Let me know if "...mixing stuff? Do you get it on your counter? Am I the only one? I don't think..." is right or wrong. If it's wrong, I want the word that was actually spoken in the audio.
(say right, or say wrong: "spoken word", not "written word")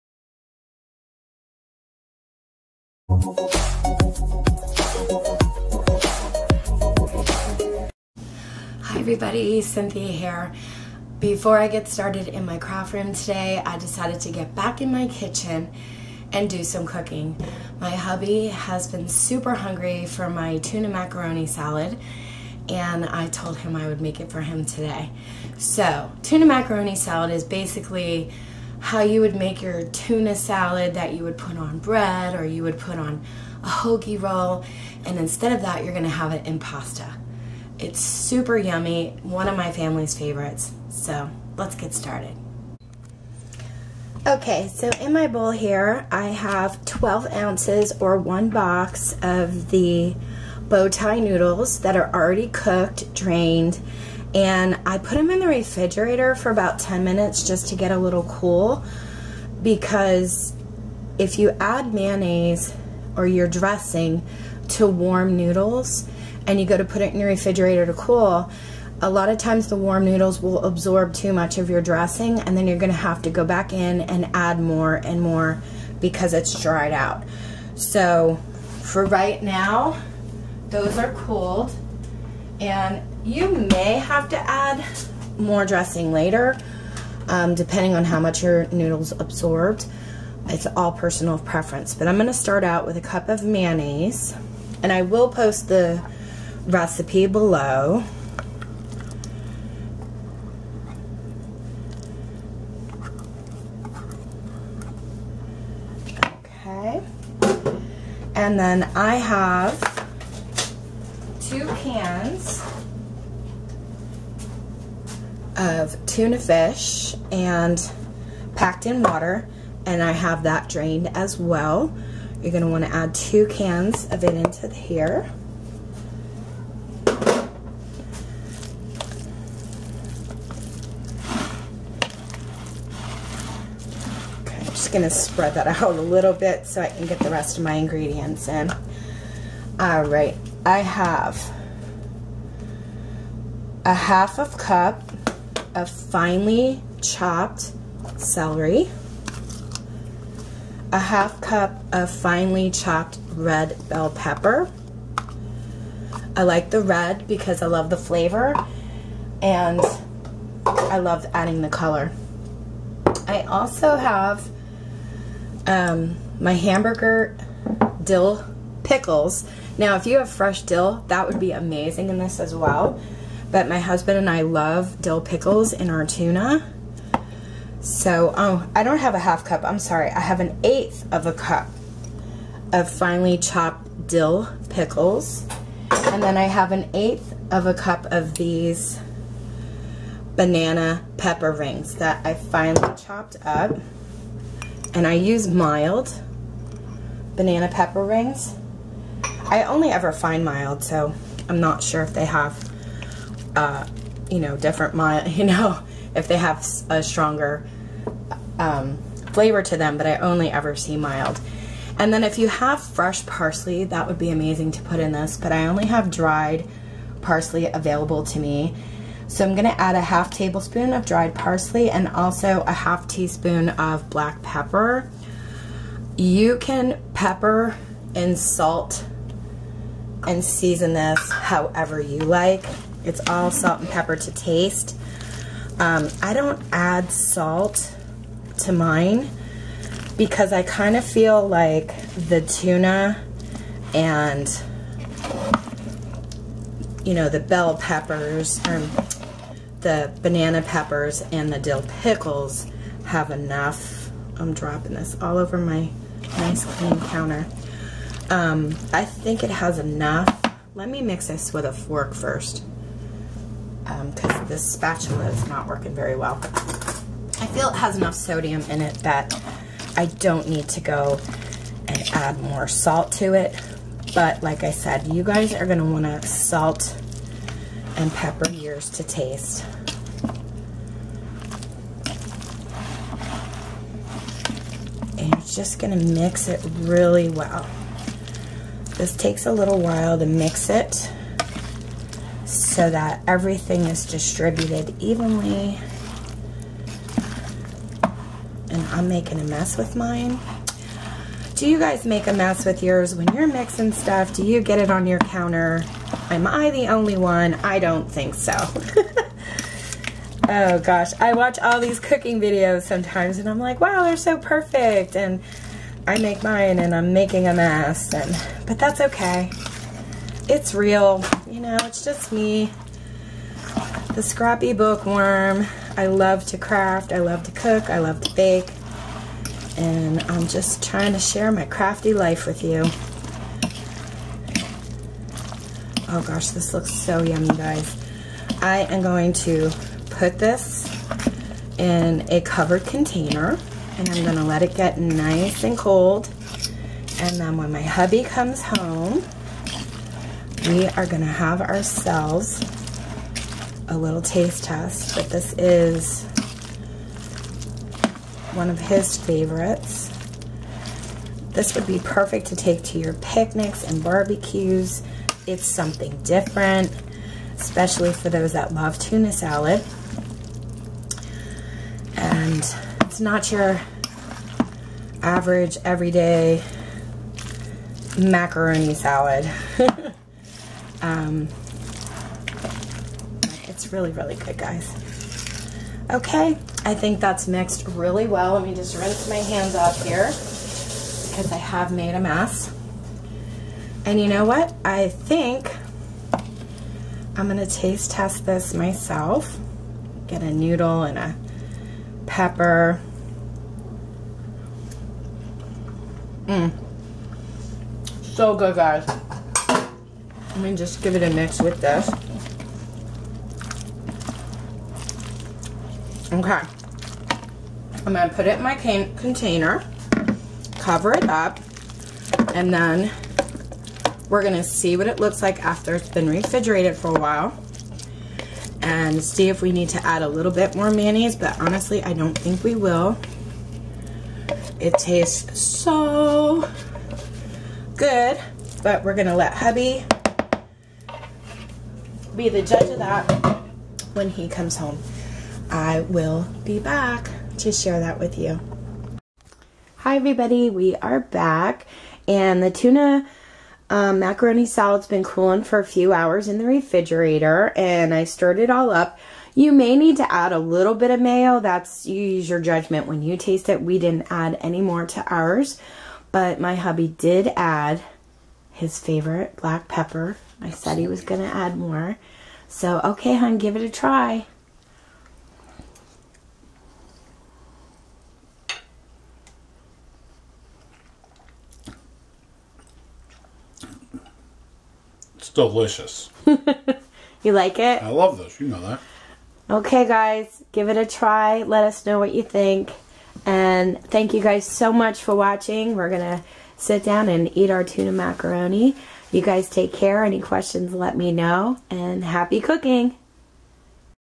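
right.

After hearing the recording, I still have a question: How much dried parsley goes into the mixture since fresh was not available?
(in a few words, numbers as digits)
half tablespoon.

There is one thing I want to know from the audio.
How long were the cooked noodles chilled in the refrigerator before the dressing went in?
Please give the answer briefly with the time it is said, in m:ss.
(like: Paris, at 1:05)
10 minutes, at 0:56.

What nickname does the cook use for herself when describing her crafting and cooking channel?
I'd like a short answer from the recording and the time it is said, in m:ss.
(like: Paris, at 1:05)
the scrappy bookworm, at 5:24.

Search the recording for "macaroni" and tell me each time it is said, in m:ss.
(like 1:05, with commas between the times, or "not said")
0:20, 0:26, 6:18, 7:34, 8:18.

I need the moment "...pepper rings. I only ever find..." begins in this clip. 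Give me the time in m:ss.
3:17.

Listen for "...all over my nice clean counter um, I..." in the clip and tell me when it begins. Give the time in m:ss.
4:15.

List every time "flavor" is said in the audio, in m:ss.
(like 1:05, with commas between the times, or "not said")
2:37, 3:29.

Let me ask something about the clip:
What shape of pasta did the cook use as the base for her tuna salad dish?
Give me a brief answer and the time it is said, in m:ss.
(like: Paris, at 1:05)
bow tie, at 0:50.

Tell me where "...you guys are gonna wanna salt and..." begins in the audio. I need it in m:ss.
4:35.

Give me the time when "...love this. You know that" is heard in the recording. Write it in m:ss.
8:08.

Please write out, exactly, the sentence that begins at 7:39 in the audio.
You may need to add a little bit of mayo.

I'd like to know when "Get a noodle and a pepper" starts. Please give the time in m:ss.
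6:40.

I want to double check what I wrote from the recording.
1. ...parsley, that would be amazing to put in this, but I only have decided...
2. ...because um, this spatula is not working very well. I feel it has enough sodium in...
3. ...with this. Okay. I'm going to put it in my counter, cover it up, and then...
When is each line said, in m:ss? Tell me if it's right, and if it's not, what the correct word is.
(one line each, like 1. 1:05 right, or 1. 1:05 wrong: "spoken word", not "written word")
1. 3:33 wrong: "dried", not "decided"
2. 4:24 right
3. 6:51 wrong: "container", not "counter".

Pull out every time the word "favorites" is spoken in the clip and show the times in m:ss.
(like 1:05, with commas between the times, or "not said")
0:40, 5:59, 7:48.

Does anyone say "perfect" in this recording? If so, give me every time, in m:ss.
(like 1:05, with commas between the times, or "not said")
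5:14, 6:02.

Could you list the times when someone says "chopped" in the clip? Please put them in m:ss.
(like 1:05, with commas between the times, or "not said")
2:27, 2:32, 3:03, 3:12.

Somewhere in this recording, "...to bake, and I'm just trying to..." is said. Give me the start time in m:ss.
5:28.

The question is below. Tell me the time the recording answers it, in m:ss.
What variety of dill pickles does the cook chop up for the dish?
2:46.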